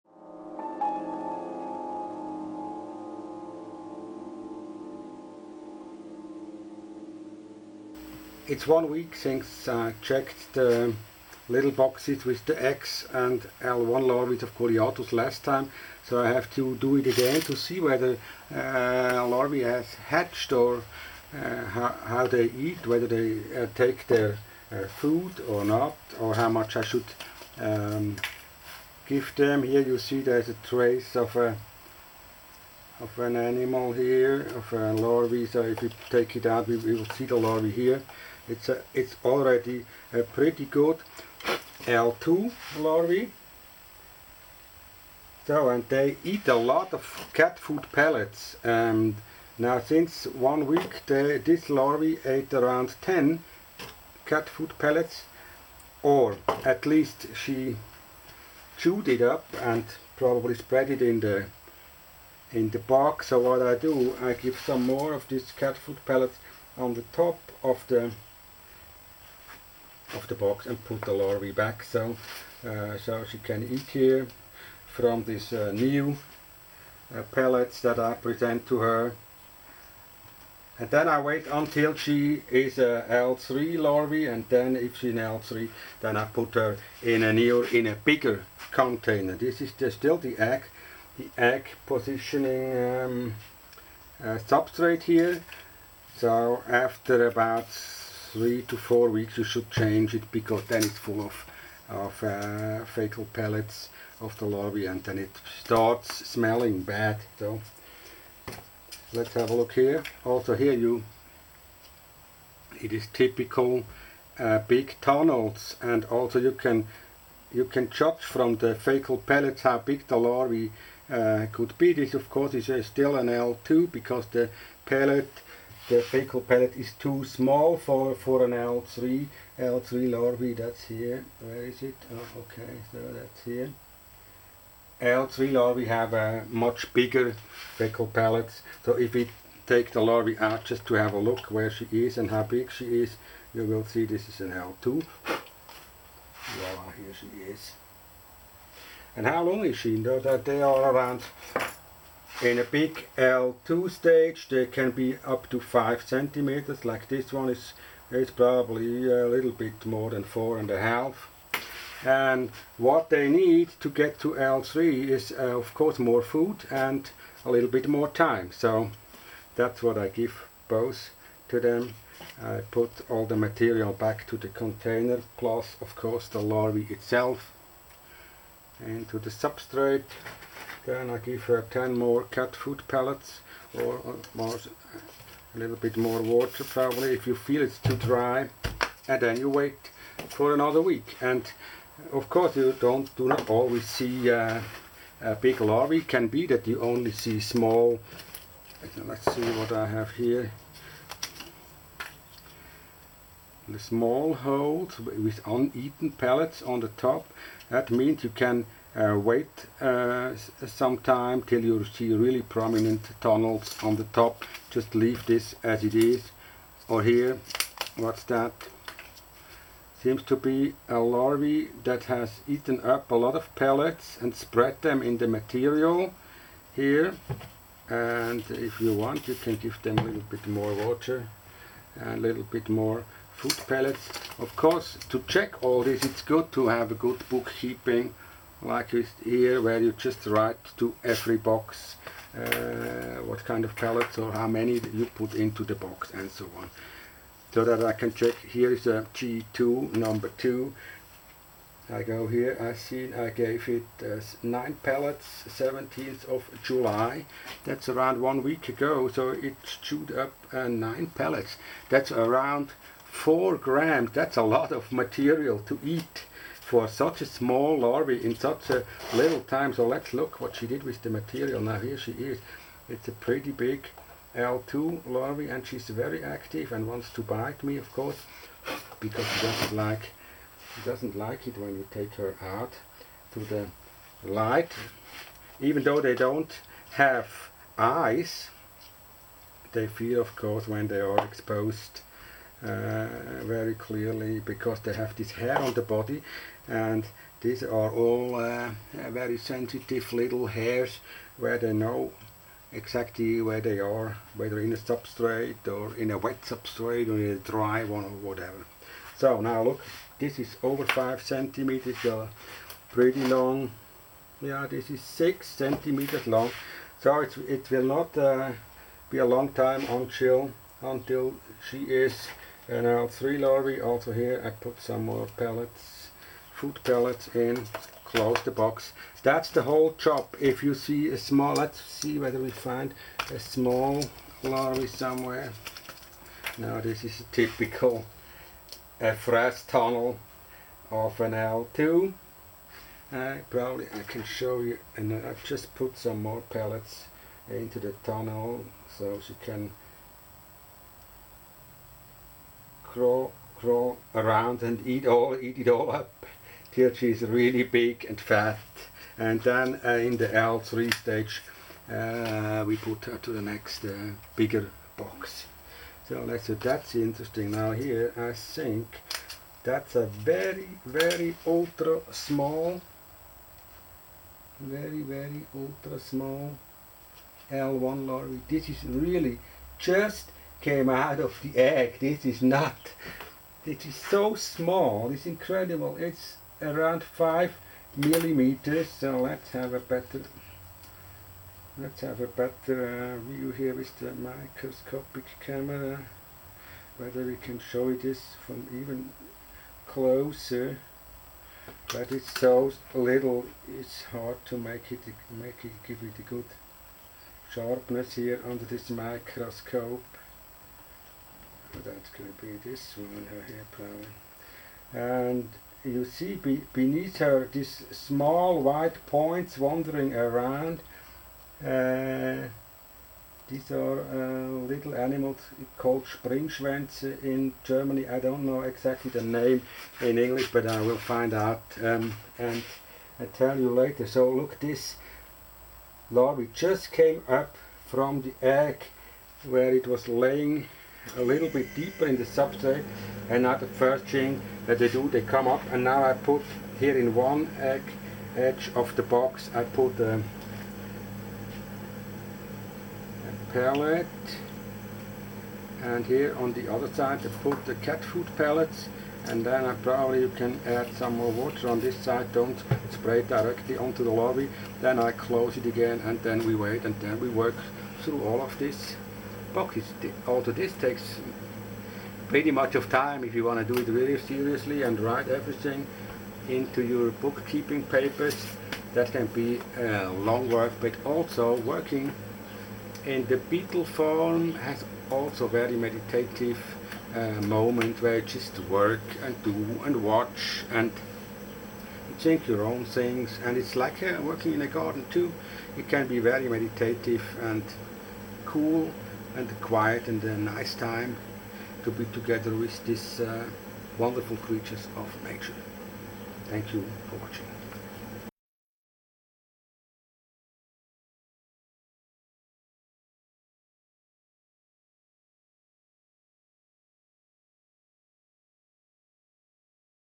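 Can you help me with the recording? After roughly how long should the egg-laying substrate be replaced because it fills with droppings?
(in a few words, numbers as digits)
3 to 4 weeks.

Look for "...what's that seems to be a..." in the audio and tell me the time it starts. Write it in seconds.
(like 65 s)
217 s.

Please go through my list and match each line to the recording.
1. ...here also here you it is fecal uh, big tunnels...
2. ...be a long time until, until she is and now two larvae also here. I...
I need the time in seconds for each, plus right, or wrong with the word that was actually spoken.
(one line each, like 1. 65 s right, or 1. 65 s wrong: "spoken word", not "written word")
1. 109 s wrong: "typical", not "fecal"
2. 319 s wrong: "three", not "two".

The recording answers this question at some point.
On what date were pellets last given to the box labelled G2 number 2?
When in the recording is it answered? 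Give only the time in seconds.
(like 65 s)
255 s.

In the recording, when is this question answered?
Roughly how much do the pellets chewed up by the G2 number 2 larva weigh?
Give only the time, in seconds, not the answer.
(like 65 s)
263 s.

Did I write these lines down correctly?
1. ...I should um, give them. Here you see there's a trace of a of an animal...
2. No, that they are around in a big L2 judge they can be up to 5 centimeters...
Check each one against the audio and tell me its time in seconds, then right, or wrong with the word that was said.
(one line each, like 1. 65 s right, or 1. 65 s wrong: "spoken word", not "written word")
1. 26 s right
2. 149 s wrong: "stage", not "judge".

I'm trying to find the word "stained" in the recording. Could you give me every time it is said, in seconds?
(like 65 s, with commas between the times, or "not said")
not said.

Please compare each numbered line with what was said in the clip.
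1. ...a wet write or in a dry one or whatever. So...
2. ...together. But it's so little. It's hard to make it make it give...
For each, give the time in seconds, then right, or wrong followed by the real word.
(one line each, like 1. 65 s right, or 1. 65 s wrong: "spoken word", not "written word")
1. 306 s wrong: "substrate", not "write"
2. 399 s wrong: "closer", not "together".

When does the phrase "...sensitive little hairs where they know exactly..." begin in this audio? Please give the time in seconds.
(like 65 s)
299 s.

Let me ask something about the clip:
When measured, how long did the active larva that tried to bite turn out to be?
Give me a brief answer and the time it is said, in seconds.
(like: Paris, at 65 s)
6 centimeters, at 315 s.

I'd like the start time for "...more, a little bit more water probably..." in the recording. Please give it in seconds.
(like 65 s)
184 s.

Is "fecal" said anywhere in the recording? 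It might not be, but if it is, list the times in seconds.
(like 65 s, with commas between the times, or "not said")
102 s, 118 s, 126 s, 137 s.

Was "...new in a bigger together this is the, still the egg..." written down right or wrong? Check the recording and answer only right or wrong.
wrong.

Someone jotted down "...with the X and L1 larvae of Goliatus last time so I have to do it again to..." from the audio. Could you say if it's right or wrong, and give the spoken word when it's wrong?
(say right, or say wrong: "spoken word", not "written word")
right.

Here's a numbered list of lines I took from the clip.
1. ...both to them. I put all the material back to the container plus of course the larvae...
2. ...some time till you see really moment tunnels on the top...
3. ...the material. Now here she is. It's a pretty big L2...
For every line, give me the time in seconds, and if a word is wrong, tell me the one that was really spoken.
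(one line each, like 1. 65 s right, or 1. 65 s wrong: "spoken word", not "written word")
1. 170 s right
2. 210 s wrong: "prominent", not "moment"
3. 271 s right.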